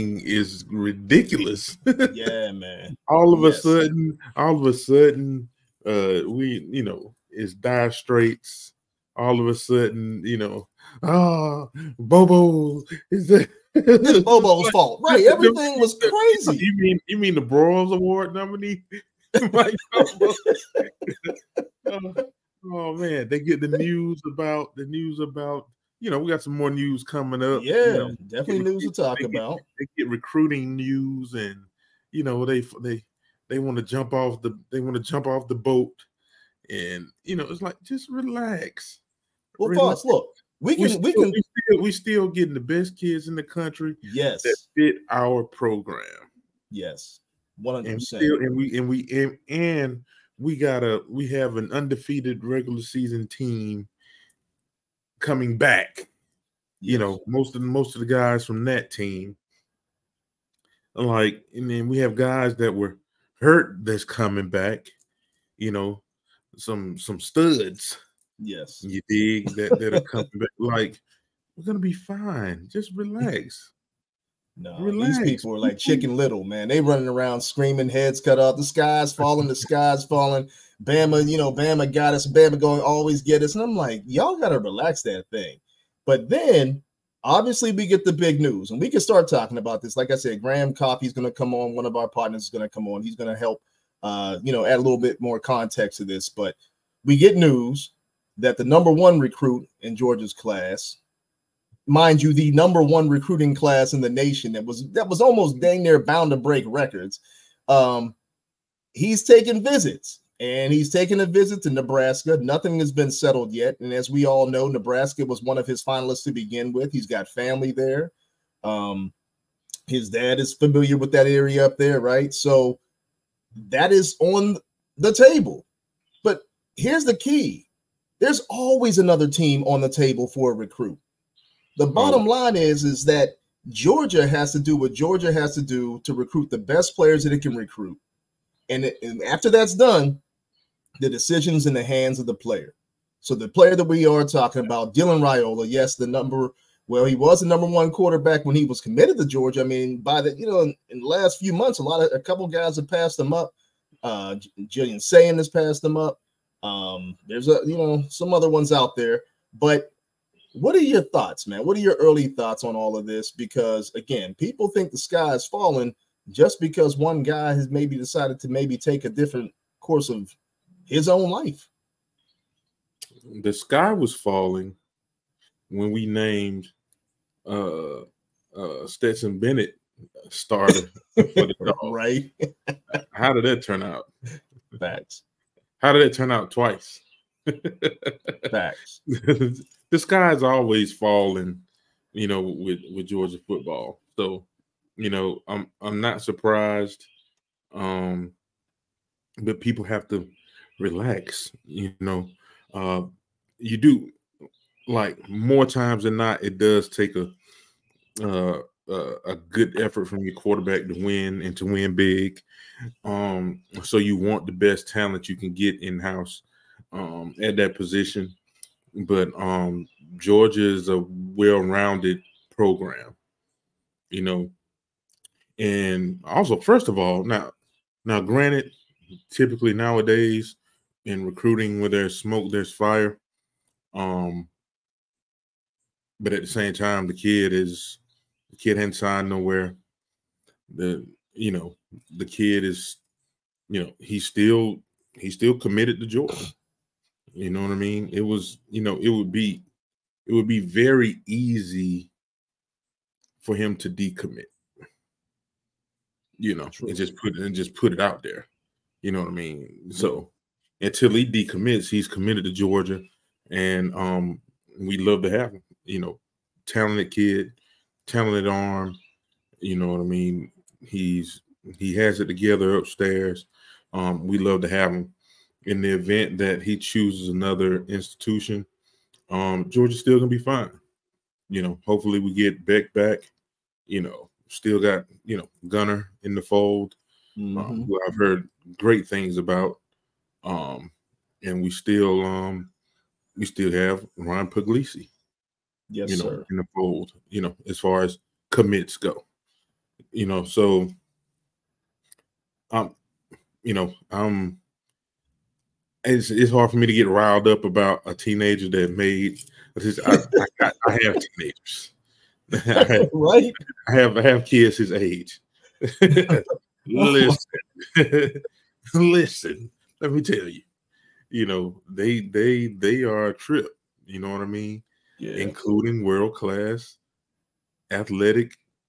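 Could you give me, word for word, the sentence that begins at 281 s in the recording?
You know, hopefully we get Beck back.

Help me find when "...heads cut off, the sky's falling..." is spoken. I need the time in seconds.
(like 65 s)
77 s.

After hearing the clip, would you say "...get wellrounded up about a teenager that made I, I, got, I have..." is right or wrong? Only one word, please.
wrong.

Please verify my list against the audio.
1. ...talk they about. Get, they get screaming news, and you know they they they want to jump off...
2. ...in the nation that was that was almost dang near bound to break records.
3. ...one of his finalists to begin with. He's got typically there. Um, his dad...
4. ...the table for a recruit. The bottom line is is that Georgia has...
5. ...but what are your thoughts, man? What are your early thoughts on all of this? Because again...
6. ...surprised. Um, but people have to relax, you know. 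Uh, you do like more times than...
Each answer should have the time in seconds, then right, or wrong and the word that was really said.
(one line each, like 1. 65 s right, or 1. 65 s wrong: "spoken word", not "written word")
1. 28 s wrong: "recruiting", not "screaming"
2. 103 s right
3. 115 s wrong: "family", not "typically"
4. 129 s right
5. 159 s right
6. 196 s right.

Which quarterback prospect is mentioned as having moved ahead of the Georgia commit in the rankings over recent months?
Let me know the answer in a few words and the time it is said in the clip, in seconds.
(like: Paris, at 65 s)
Julian Sayin, at 154 s.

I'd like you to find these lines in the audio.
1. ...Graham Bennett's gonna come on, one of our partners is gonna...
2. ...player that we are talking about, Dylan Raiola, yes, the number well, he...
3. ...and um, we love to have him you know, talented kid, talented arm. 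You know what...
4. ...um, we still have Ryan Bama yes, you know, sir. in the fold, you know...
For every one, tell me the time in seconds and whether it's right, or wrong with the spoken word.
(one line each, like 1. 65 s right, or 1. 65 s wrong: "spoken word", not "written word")
1. 90 s wrong: "Coffey", not "Bennett"
2. 143 s right
3. 263 s right
4. 292 s wrong: "Puglisi", not "Bama".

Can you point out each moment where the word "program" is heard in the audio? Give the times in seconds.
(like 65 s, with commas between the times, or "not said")
45 s, 222 s.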